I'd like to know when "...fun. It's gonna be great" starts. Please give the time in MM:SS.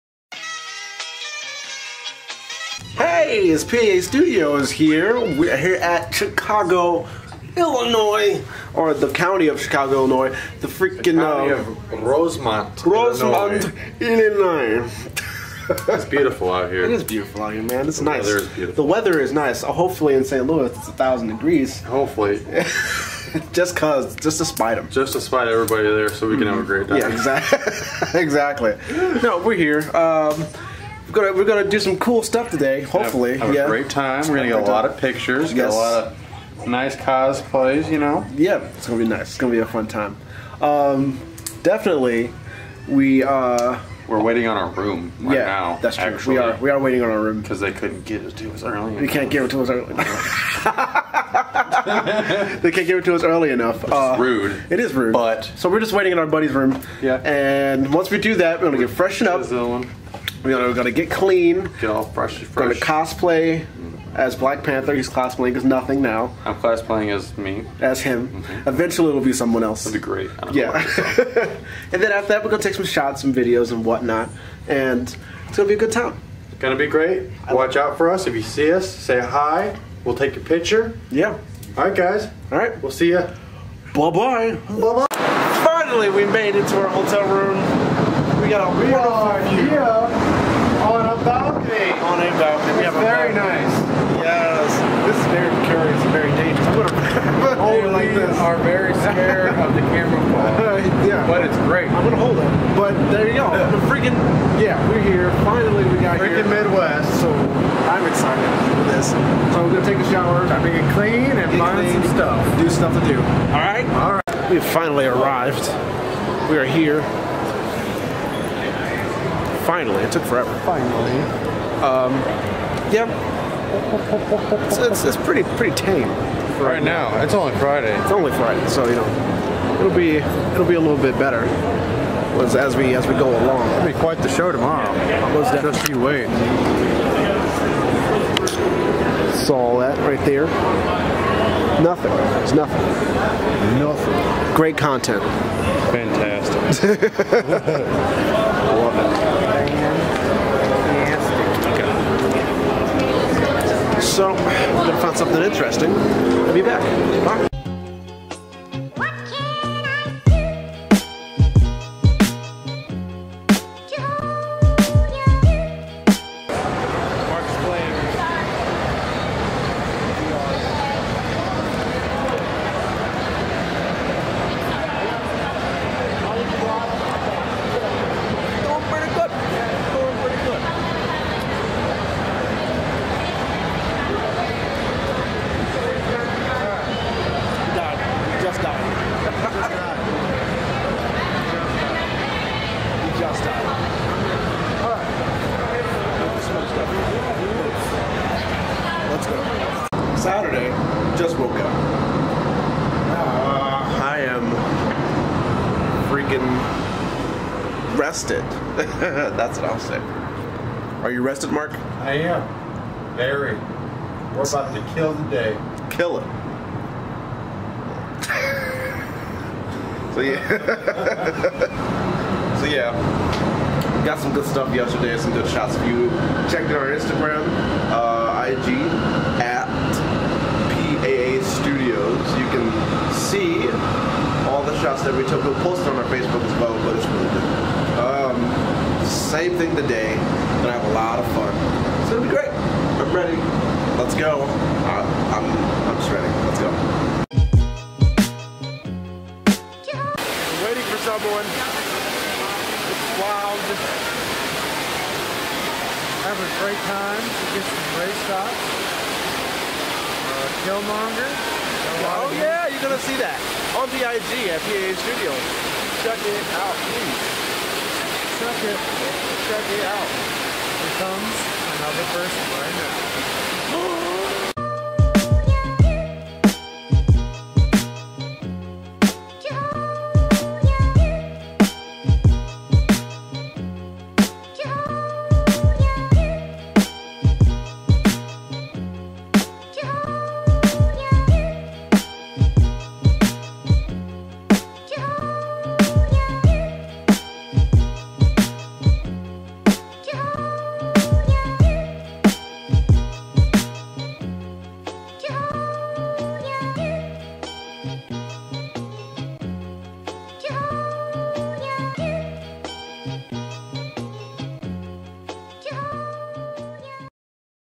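04:01.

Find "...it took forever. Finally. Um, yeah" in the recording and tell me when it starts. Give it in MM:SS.
02:00.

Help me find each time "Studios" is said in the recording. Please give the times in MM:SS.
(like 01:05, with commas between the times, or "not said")
00:04, 04:24.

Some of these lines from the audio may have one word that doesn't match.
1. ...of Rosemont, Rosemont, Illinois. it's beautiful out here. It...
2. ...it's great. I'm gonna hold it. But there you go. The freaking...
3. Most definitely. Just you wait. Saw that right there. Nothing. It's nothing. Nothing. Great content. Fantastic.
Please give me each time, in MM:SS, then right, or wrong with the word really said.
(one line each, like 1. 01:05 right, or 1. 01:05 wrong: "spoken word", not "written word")
1. 00:11 right
2. 01:41 right
3. 02:15 right.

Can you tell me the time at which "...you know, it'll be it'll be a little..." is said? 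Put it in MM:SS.
02:08.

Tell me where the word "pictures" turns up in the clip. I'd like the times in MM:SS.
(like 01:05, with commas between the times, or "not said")
00:34, 01:20.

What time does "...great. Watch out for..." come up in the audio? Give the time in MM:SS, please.
01:16.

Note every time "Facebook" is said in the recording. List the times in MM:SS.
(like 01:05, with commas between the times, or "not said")
03:56.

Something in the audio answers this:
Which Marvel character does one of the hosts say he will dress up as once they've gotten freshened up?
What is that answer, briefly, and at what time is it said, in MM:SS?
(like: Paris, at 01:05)
Black Panther, at 01:04.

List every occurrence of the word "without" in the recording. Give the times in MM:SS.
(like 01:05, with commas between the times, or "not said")
not said.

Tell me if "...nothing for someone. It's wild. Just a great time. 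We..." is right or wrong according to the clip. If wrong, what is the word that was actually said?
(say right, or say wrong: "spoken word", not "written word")
wrong: "waiting", not "nothing".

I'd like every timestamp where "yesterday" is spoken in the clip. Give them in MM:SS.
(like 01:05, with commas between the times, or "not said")
03:44.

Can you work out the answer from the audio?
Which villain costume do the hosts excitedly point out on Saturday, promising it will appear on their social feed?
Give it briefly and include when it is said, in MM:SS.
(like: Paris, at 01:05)
Killmonger, at 04:20.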